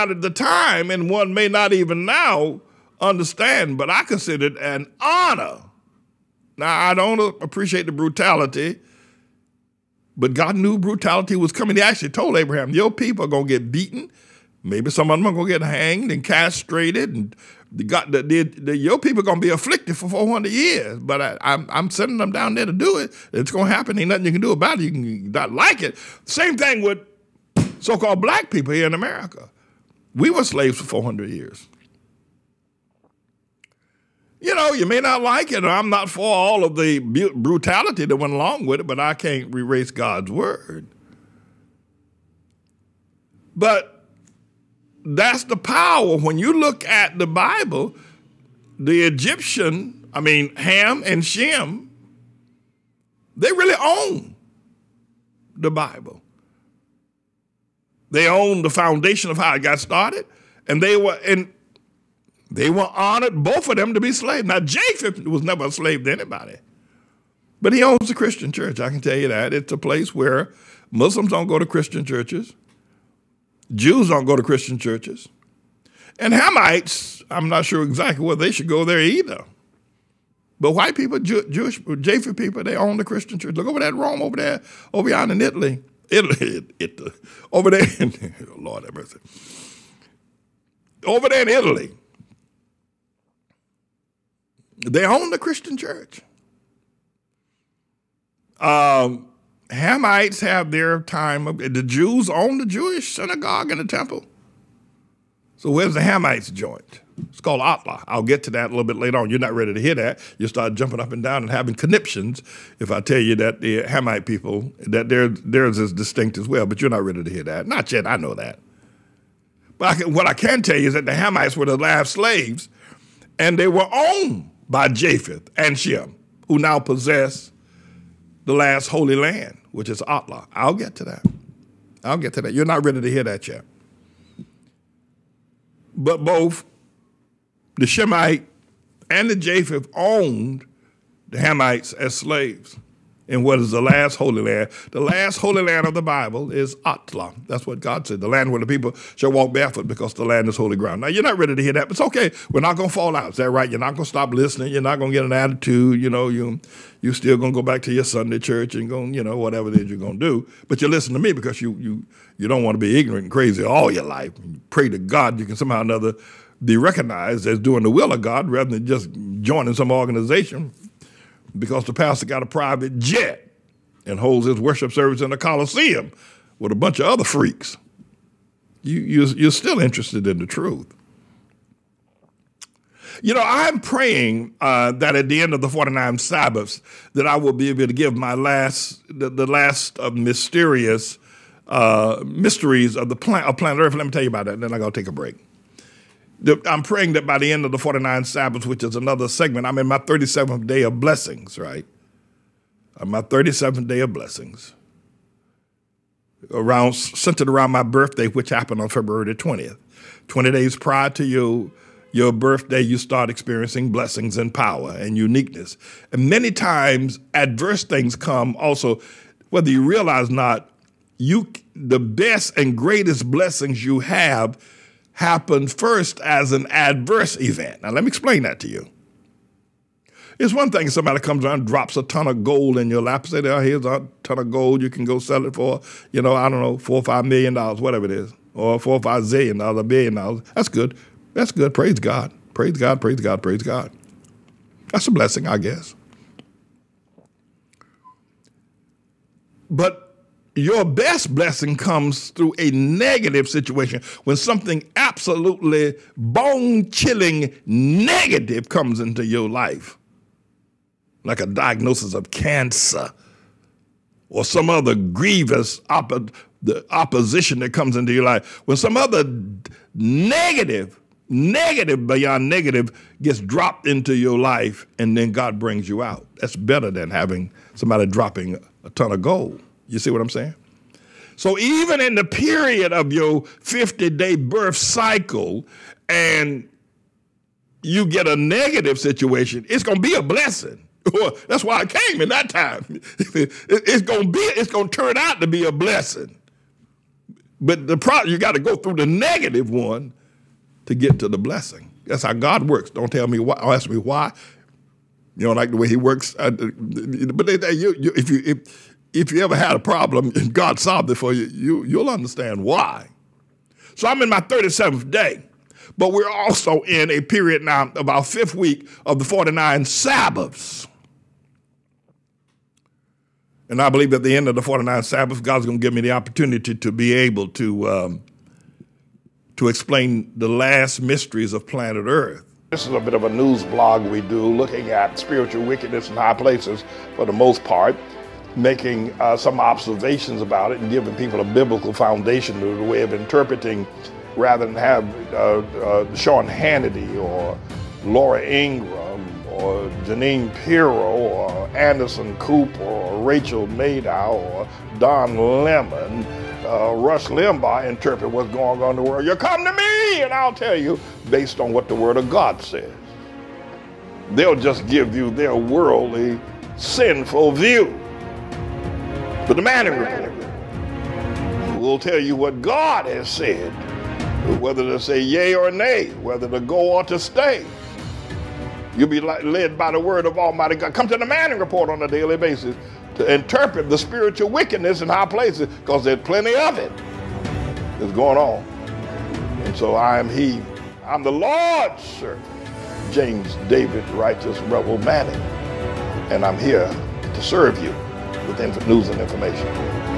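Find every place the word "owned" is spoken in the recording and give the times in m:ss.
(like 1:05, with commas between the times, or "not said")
2:03, 2:19.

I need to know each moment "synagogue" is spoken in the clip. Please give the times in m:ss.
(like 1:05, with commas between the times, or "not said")
1:43.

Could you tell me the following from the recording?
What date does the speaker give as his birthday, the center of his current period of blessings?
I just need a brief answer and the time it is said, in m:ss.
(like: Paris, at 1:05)
February 20, at 3:28.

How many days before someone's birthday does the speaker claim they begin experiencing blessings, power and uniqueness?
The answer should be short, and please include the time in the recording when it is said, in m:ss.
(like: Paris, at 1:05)
20, at 3:30.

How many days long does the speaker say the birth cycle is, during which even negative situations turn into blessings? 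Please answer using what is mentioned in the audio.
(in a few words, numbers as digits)
50.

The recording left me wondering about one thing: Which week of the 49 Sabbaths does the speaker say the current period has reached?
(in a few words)
fifth.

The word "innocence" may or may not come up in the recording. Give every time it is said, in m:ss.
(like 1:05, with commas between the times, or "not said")
not said.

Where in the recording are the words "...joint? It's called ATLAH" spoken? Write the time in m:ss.
1:46.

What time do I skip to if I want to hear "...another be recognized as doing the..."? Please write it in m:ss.
2:45.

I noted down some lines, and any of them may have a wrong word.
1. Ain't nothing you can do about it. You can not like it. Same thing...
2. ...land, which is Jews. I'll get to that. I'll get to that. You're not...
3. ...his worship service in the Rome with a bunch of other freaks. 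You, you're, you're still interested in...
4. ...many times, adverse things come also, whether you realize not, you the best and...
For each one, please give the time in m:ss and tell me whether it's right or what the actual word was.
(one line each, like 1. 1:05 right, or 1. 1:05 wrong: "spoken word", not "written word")
1. 0:23 right
2. 2:09 wrong: "ATLAH", not "Jews"
3. 2:54 wrong: "Coliseum", not "Rome"
4. 3:36 right.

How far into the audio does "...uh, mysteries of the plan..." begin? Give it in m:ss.
3:11.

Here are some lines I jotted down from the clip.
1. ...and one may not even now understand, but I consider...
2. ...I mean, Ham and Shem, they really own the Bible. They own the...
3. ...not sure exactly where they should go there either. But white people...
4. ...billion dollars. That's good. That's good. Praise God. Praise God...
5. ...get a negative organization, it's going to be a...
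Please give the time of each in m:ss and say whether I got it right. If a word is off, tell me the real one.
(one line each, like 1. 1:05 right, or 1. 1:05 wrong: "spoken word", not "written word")
1. 0:00 right
2. 0:50 right
3. 1:17 right
4. 3:59 right
5. 4:48 wrong: "situation", not "organization".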